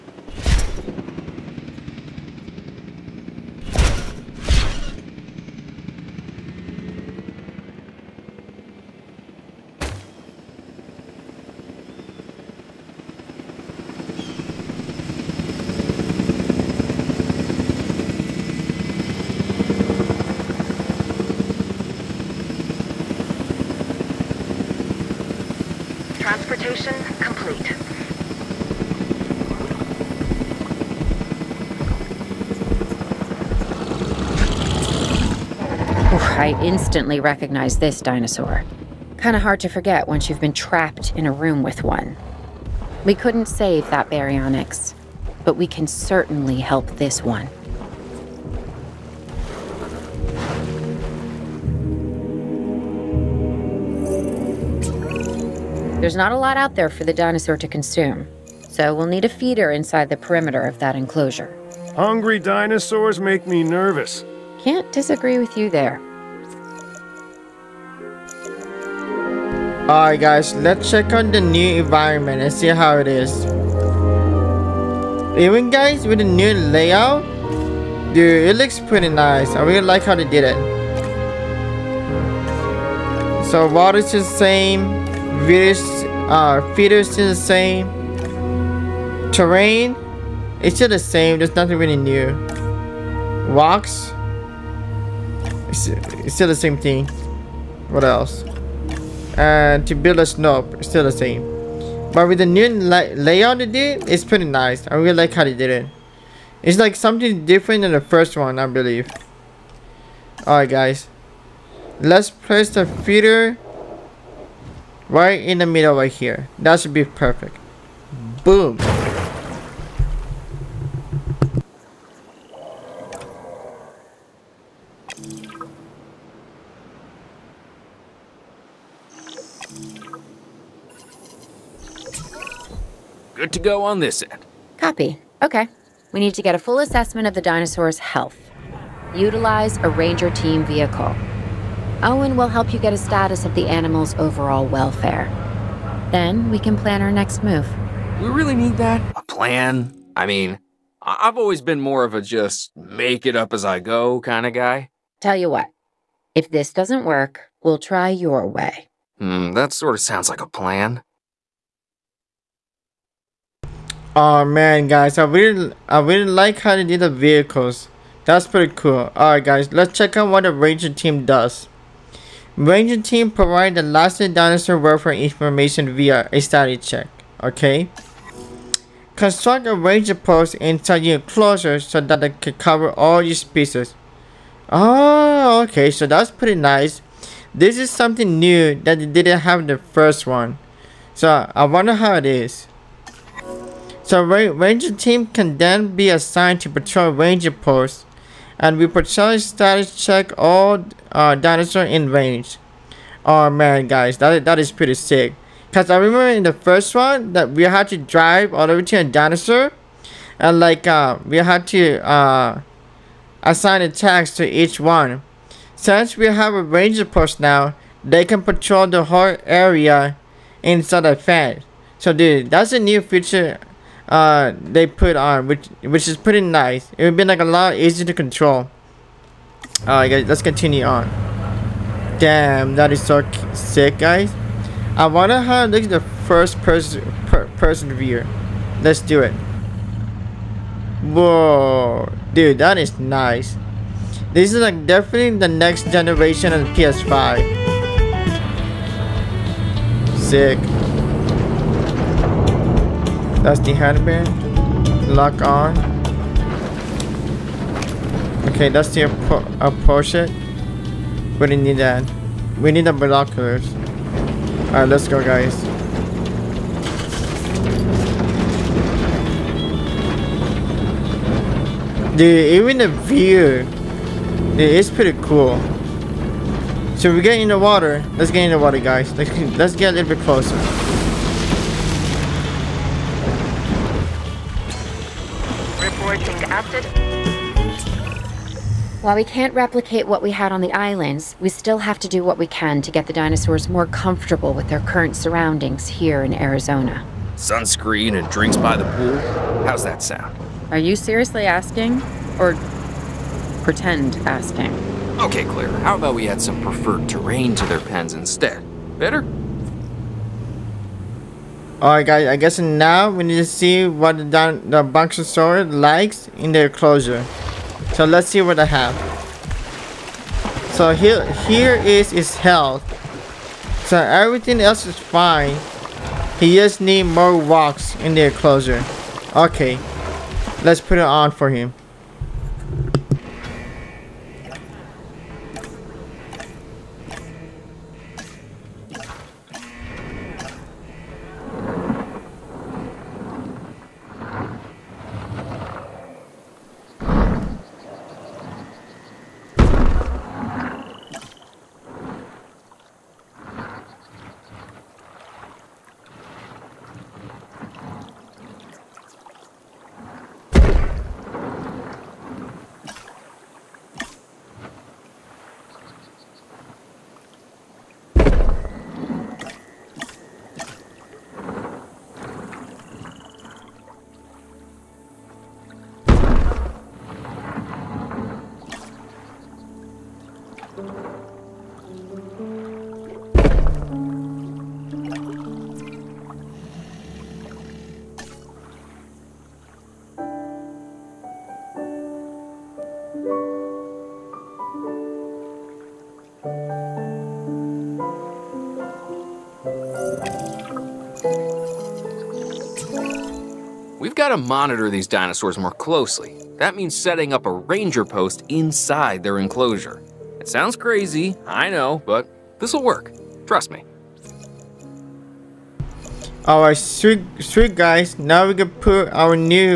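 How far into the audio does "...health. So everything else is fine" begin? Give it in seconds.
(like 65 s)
322 s.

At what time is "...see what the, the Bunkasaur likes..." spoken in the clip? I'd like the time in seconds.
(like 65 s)
313 s.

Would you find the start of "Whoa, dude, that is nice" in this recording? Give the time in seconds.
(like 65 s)
241 s.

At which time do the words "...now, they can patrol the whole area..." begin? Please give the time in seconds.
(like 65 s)
217 s.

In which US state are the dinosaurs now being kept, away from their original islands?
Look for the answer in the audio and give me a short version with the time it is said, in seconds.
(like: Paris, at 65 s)
Arizona, at 296 s.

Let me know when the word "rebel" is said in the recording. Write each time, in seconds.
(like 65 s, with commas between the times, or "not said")
not said.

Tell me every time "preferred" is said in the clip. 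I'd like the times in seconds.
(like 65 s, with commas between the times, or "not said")
306 s.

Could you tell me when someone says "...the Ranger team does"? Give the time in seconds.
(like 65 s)
170 s.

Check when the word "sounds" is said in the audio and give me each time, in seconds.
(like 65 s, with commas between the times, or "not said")
160 s, 300 s, 410 s.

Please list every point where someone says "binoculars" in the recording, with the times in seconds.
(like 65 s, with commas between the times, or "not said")
262 s.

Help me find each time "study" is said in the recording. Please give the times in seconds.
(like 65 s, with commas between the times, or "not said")
176 s.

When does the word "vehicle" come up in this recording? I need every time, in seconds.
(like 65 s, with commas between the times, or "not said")
140 s, 167 s.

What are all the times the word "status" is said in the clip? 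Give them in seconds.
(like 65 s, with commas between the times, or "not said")
142 s, 199 s.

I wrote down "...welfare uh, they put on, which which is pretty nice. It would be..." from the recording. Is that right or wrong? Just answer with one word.
wrong.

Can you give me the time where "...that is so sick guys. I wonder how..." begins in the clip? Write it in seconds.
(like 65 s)
232 s.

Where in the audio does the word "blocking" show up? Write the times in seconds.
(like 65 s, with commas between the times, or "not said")
not said.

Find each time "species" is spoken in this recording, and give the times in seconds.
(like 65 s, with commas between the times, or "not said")
183 s.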